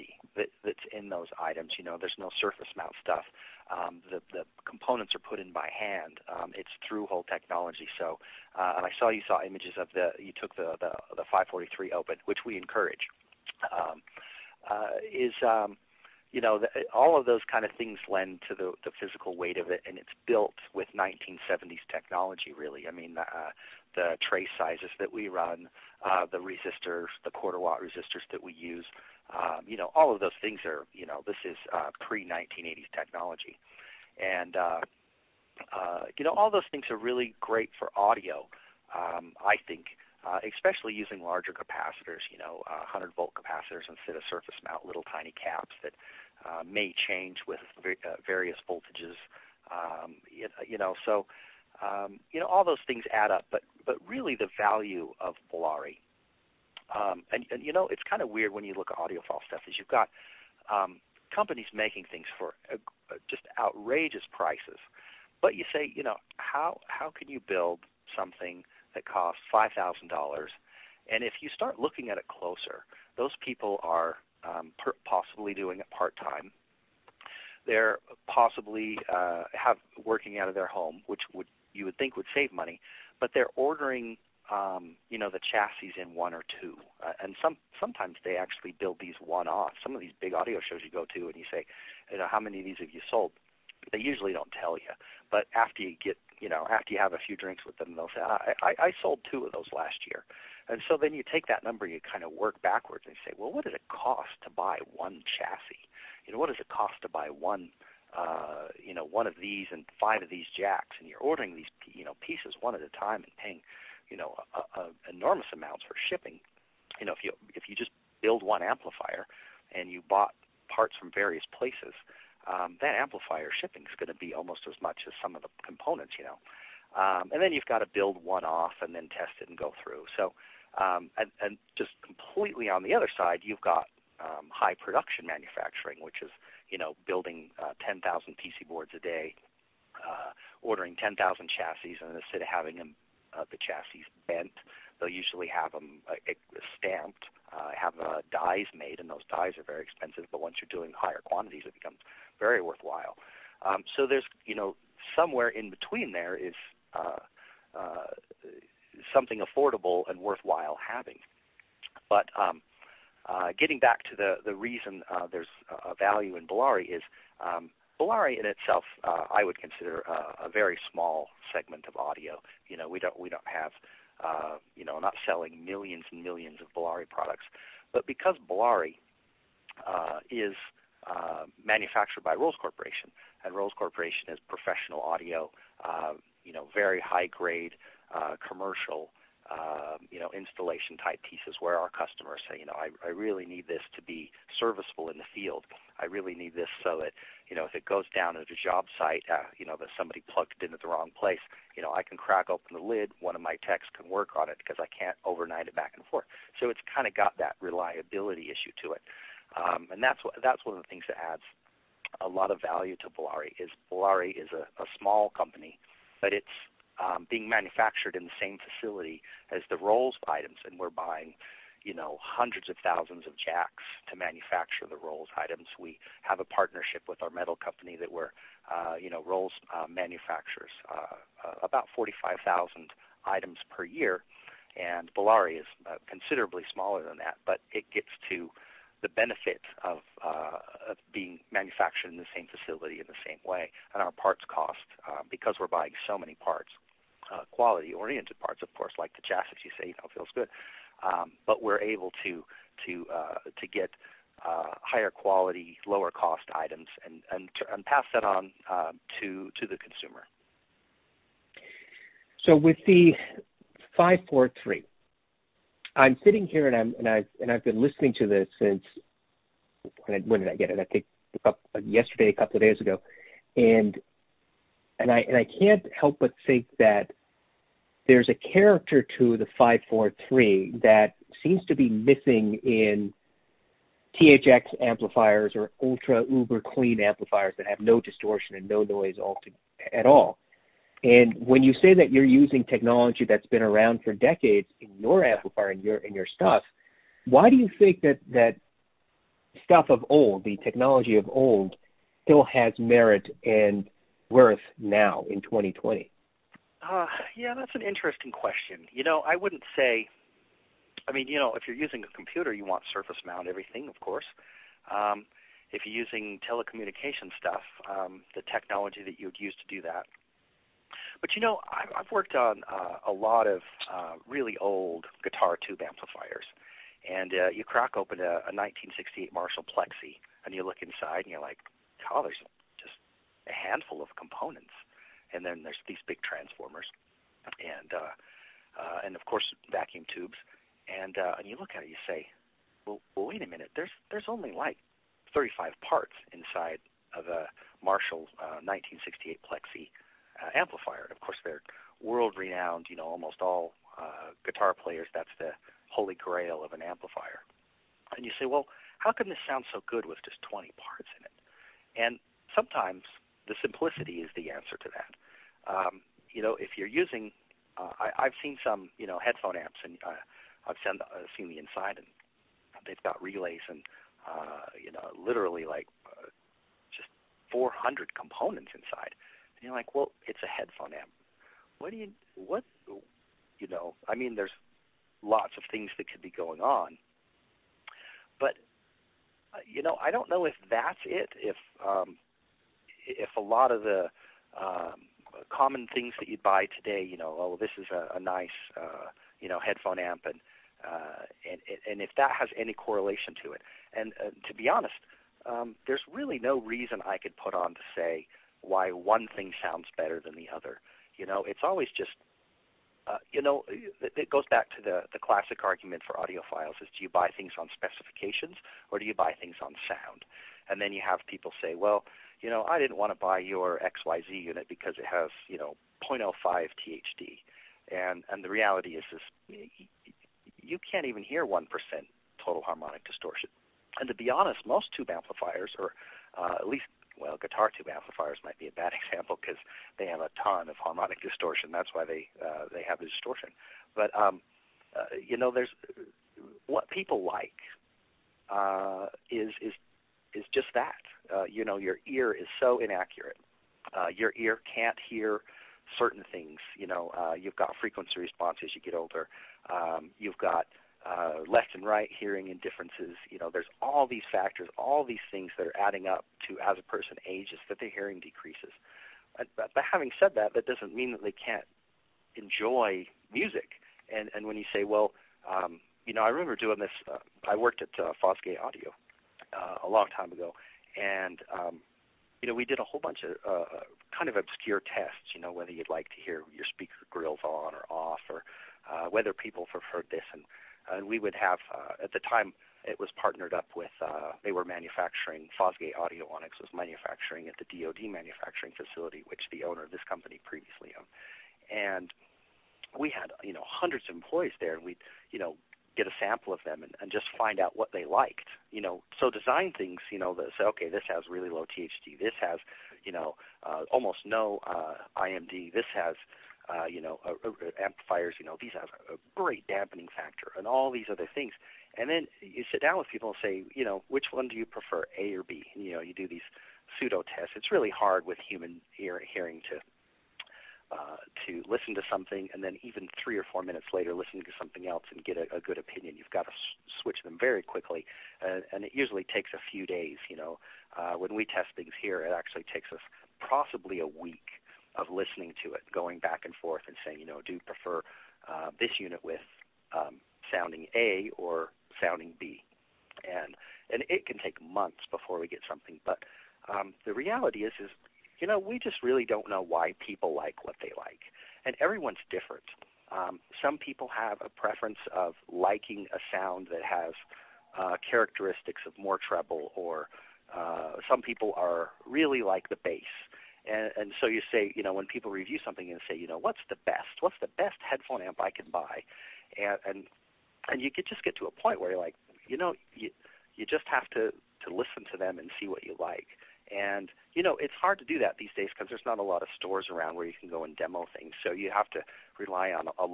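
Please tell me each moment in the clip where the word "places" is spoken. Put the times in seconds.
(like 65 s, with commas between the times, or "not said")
121 s, 201 s.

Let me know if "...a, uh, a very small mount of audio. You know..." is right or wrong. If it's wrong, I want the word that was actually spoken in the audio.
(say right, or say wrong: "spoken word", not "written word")
wrong: "segment", not "mount".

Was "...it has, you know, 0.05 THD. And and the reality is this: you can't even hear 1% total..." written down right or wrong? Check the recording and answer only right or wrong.
right.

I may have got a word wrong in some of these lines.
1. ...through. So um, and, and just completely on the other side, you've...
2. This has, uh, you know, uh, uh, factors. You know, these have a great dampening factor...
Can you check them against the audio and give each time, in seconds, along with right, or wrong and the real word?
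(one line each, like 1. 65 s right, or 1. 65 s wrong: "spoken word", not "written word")
1. 129 s right
2. 515 s wrong: "amplifiers", not "factors".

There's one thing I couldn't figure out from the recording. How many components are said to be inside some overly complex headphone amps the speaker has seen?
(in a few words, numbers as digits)
400.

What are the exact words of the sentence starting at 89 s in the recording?
Some of these big audio shows you go to, and you say, you know, how many of these have you sold?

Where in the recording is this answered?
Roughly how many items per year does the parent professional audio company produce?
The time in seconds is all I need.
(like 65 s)
231 s.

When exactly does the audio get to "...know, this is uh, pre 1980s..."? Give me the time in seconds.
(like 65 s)
31 s.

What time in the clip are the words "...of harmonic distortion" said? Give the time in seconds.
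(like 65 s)
440 s.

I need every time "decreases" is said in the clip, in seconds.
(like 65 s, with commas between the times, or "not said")
468 s.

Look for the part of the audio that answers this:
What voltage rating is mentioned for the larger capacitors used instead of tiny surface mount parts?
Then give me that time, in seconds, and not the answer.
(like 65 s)
42 s.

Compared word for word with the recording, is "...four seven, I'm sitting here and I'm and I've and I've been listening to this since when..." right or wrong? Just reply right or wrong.
wrong.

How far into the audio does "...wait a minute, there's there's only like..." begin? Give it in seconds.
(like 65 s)
343 s.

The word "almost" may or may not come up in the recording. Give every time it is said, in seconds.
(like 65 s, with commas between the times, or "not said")
124 s, 353 s, 513 s.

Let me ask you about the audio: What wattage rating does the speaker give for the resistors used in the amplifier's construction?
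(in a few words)
quarter watt.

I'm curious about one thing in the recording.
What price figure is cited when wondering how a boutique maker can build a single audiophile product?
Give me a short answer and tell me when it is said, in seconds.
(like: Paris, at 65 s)
$5,000, at 69 s.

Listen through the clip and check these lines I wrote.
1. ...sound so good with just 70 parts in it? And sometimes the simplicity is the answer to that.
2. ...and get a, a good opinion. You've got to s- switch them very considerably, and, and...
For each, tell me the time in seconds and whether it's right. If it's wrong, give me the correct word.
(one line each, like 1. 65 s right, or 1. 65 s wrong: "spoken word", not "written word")
1. 359 s wrong: "20", not "70"
2. 535 s wrong: "quickly", not "considerably".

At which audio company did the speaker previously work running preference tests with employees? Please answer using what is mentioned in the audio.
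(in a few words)
Fosgate Audio.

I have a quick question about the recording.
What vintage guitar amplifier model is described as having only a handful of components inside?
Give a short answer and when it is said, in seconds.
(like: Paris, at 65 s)
Marshall Plexi, at 329 s.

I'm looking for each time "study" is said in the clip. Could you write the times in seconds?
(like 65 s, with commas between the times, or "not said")
not said.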